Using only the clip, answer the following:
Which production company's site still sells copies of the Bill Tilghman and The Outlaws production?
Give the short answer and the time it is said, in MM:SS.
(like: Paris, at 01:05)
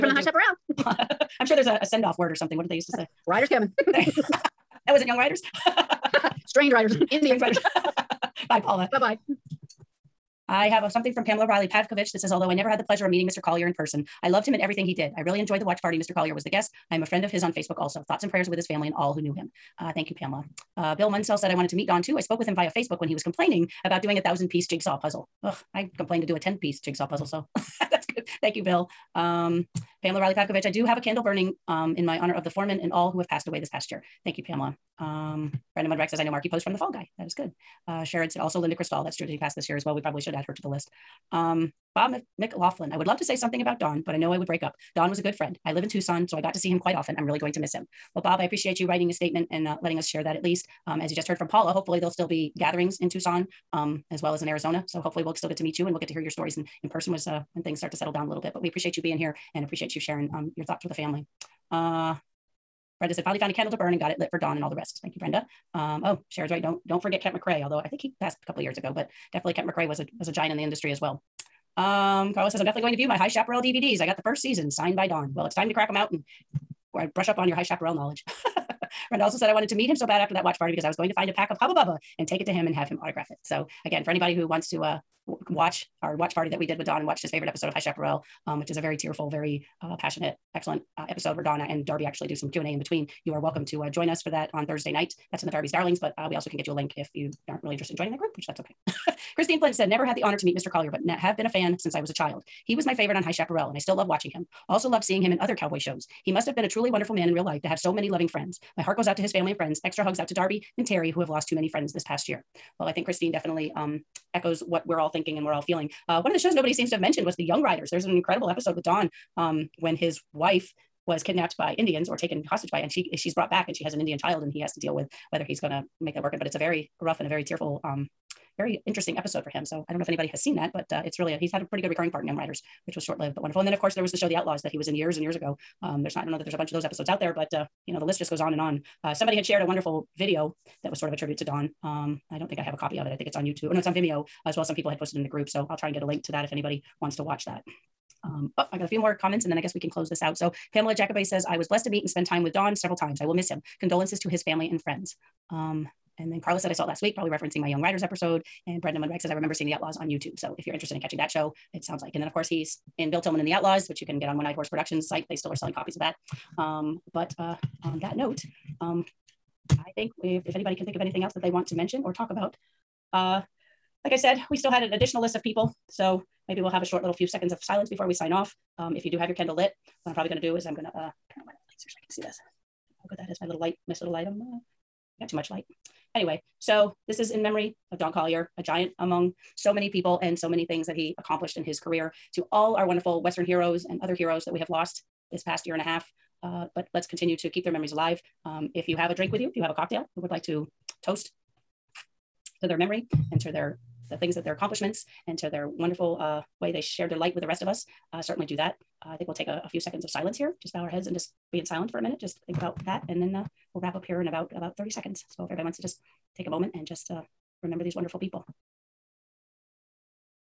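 One Eyed Horse Productions, at 02:44.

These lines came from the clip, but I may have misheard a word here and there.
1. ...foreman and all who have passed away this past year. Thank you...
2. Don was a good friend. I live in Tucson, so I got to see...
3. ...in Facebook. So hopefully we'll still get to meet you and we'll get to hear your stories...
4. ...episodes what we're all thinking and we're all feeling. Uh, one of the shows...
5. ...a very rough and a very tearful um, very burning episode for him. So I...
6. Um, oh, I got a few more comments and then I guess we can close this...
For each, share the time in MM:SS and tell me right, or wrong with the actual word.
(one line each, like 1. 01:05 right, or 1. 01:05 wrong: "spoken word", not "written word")
1. 00:32 right
2. 00:44 right
3. 00:54 wrong: "Arizona", not "Facebook"
4. 01:54 wrong: "echoes", not "episodes"
5. 02:06 wrong: "interesting", not "burning"
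6. 02:28 right.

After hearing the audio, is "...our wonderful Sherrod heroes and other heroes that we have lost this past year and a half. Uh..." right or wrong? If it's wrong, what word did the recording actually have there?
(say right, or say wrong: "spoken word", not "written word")
wrong: "Western", not "Sherrod".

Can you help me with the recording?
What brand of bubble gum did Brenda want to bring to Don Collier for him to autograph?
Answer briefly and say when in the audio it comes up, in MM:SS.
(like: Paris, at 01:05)
Hubba Bubba, at 01:21.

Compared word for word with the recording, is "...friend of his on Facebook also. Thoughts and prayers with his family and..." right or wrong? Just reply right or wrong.
right.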